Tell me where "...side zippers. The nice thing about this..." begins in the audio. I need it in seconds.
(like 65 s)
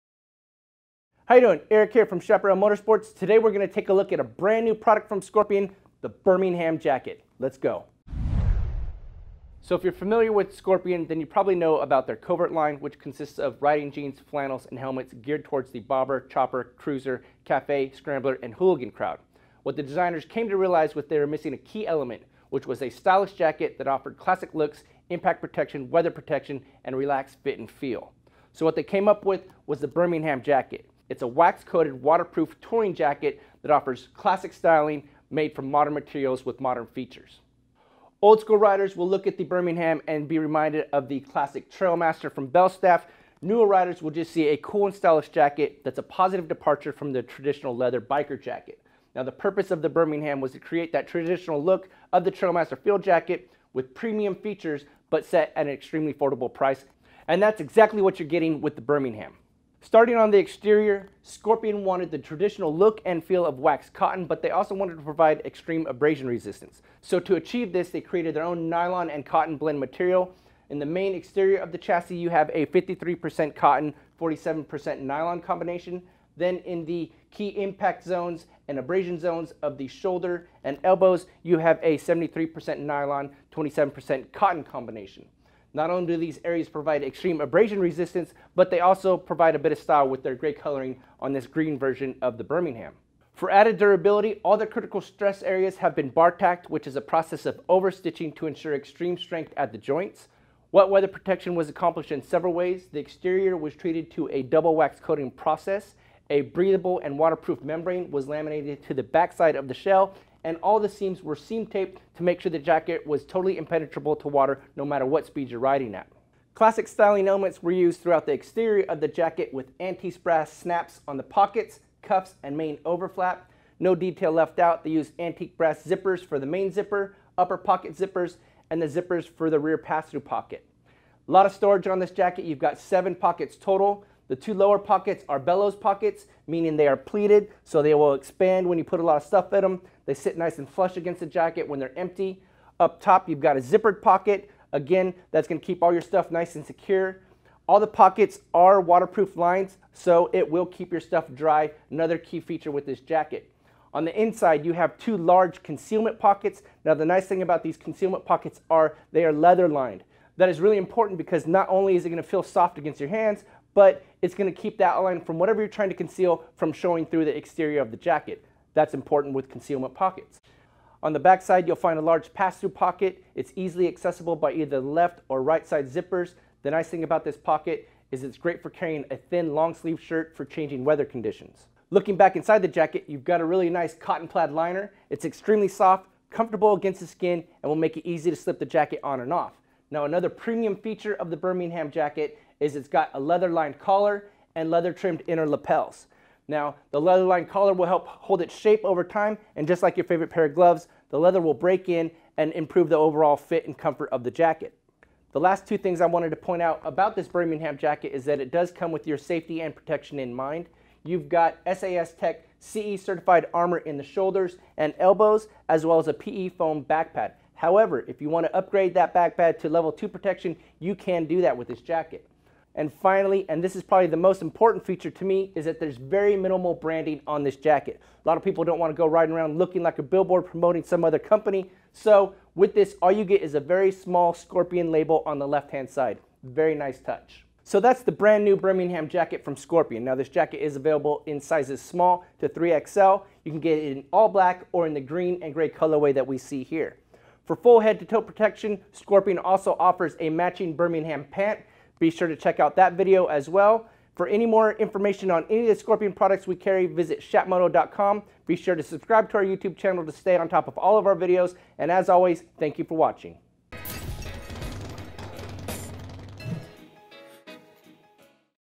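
175 s.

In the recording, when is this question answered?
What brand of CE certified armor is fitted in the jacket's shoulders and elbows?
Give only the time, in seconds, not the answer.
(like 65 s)
211 s.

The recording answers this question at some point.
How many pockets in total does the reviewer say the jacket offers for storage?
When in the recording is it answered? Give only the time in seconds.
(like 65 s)
132 s.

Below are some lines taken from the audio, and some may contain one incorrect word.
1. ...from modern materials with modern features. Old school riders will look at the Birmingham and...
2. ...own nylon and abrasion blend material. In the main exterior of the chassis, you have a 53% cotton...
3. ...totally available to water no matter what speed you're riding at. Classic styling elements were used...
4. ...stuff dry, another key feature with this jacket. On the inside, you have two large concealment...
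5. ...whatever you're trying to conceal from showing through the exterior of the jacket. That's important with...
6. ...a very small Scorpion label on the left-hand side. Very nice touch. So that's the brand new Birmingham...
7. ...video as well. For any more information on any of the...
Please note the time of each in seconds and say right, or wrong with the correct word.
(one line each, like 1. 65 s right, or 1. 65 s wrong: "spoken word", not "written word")
1. 35 s right
2. 68 s wrong: "cotton", not "abrasion"
3. 113 s wrong: "impenetrable", not "available"
4. 151 s right
5. 165 s right
6. 233 s right
7. 252 s right.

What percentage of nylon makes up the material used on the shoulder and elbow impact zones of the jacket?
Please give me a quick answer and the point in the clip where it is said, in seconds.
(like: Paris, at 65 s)
73%, at 81 s.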